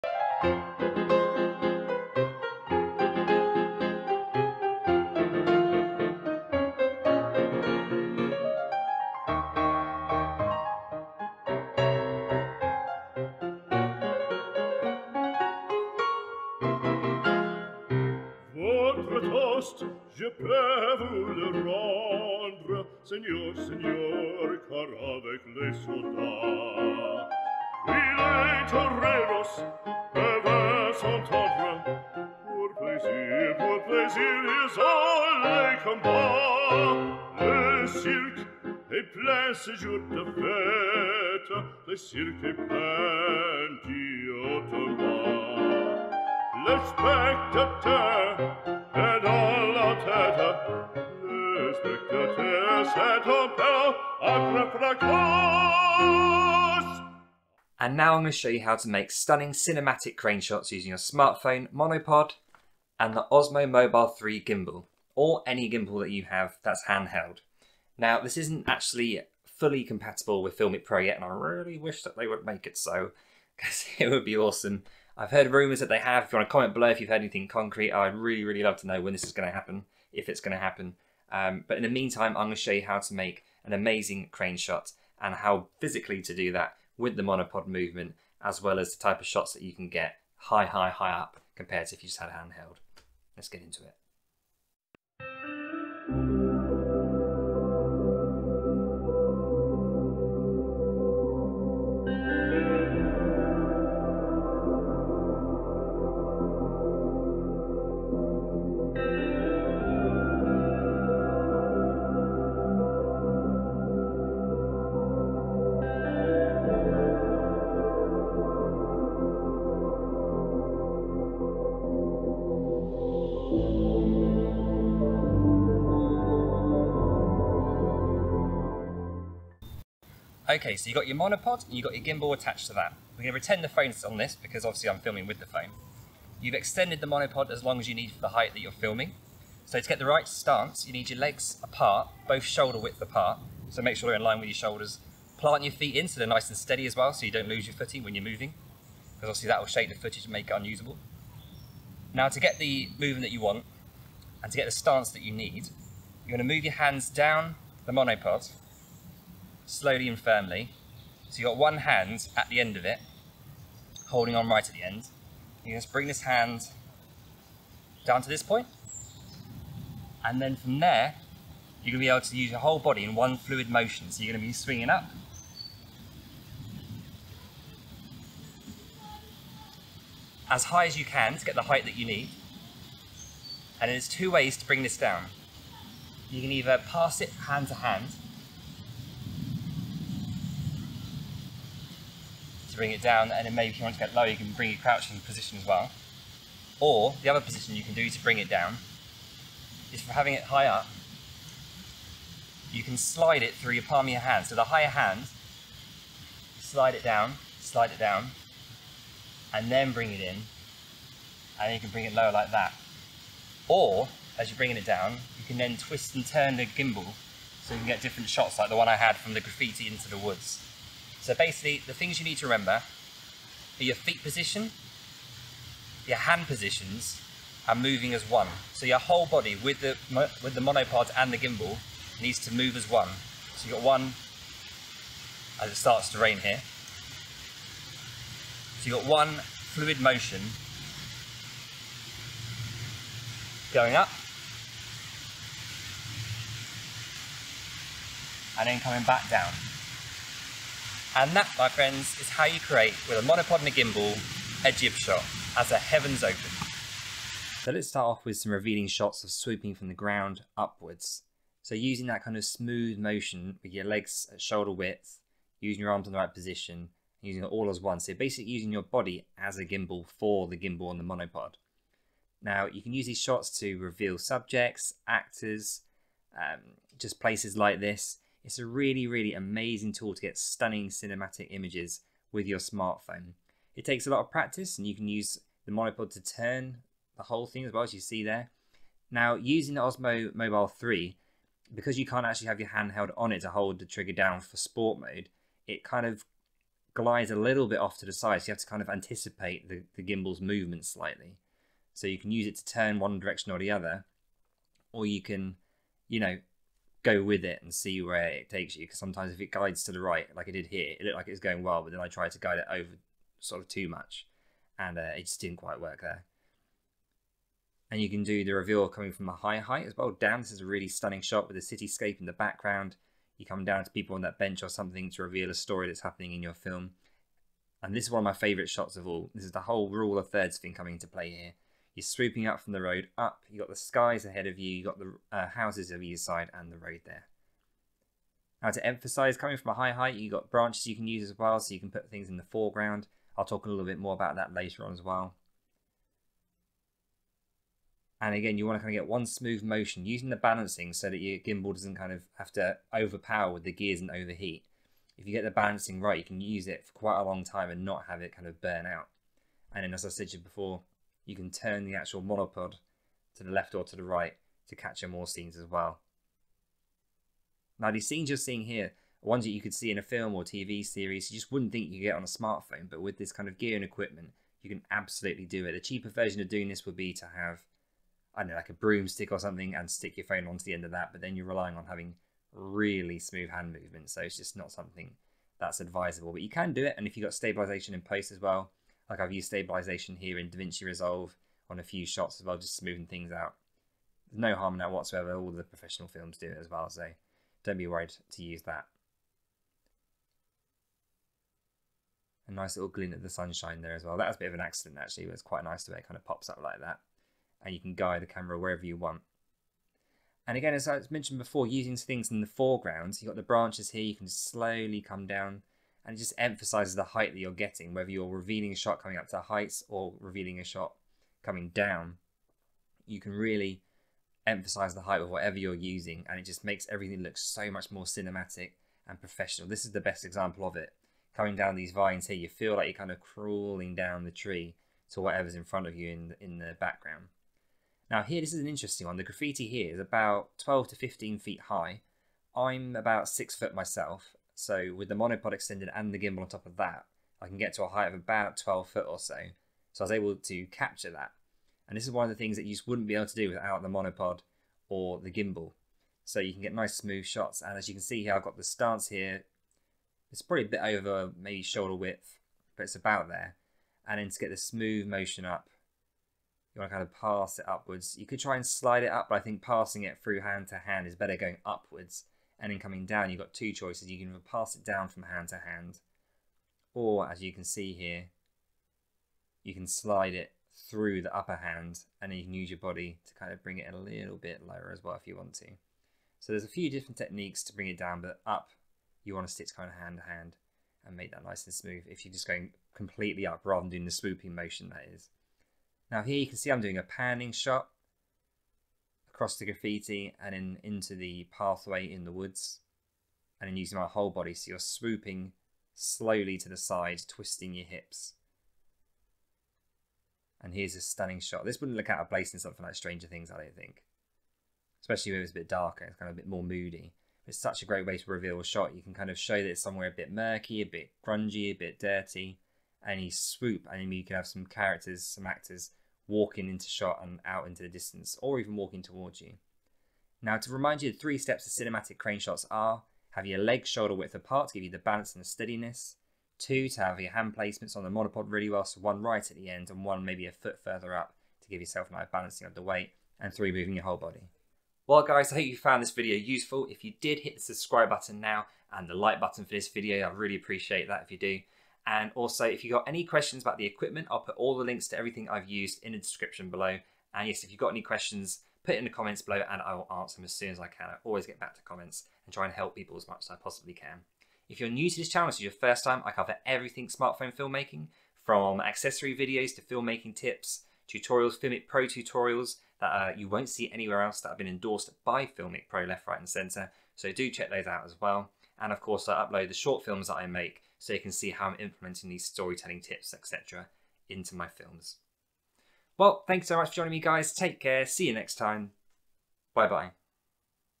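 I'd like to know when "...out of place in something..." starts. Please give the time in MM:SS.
08:32.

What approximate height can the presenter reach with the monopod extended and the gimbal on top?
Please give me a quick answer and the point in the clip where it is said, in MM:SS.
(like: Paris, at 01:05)
12 foot, at 07:28.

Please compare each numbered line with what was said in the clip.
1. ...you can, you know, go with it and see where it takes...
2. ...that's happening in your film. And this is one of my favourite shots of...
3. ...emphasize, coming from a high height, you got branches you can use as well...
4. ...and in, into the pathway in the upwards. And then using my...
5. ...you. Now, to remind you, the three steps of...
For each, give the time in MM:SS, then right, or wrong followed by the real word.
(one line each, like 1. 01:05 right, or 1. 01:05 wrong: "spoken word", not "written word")
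1. 05:05 right
2. 05:25 right
3. 05:38 right
4. 08:20 wrong: "woods", not "upwards"
5. 08:49 right.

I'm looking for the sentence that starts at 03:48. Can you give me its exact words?
So your whole body with the, with the monopod and the gimbal needs to move as one.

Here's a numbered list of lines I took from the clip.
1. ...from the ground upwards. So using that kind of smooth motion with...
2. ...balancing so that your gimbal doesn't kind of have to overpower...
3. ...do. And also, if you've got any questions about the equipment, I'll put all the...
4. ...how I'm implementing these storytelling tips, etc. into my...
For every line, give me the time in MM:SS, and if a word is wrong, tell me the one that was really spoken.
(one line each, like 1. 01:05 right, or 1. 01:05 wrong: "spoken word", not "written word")
1. 04:19 right
2. 05:50 right
3. 09:11 right
4. 09:41 right.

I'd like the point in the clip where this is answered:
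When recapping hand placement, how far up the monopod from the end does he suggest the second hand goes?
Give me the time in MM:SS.
09:00.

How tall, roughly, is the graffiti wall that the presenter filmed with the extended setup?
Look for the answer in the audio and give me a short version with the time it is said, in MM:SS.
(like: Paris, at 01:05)
12 to 15 feet, at 07:20.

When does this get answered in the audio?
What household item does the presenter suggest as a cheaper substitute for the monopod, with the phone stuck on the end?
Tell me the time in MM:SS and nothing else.
06:18.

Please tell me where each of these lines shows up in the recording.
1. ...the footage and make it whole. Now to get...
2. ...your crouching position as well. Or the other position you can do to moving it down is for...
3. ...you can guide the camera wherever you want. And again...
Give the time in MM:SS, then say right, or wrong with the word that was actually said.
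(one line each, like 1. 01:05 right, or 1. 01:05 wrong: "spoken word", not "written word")
1. 02:29 wrong: "unusable", not "whole"
2. 03:14 wrong: "bring", not "moving"
3. 06:47 right.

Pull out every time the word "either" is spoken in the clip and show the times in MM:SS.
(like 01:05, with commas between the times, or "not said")
03:06, 05:36, 07:54.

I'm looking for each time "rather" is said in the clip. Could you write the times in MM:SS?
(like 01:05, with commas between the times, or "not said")
08:13.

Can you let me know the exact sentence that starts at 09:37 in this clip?
So do check those out as well.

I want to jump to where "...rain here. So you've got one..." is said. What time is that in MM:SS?
03:56.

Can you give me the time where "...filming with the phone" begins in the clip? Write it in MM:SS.
02:14.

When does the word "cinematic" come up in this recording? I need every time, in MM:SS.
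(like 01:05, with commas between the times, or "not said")
00:59, 04:40, 07:08, 08:51.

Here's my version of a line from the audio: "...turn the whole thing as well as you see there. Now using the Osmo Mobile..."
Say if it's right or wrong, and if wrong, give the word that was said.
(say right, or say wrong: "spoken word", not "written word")
right.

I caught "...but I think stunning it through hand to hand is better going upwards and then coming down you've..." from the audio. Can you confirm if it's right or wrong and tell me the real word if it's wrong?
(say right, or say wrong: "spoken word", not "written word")
wrong: "passing", not "stunning".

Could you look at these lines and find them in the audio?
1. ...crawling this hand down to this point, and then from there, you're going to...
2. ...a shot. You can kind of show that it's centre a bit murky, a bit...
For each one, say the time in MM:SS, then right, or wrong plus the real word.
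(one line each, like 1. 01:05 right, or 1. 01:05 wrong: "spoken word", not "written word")
1. 02:45 wrong: "bring", not "crawling"
2. 08:38 wrong: "somewhere", not "centre".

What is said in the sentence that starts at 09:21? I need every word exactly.
I always get back to comments and try and help people as much as I possibly can.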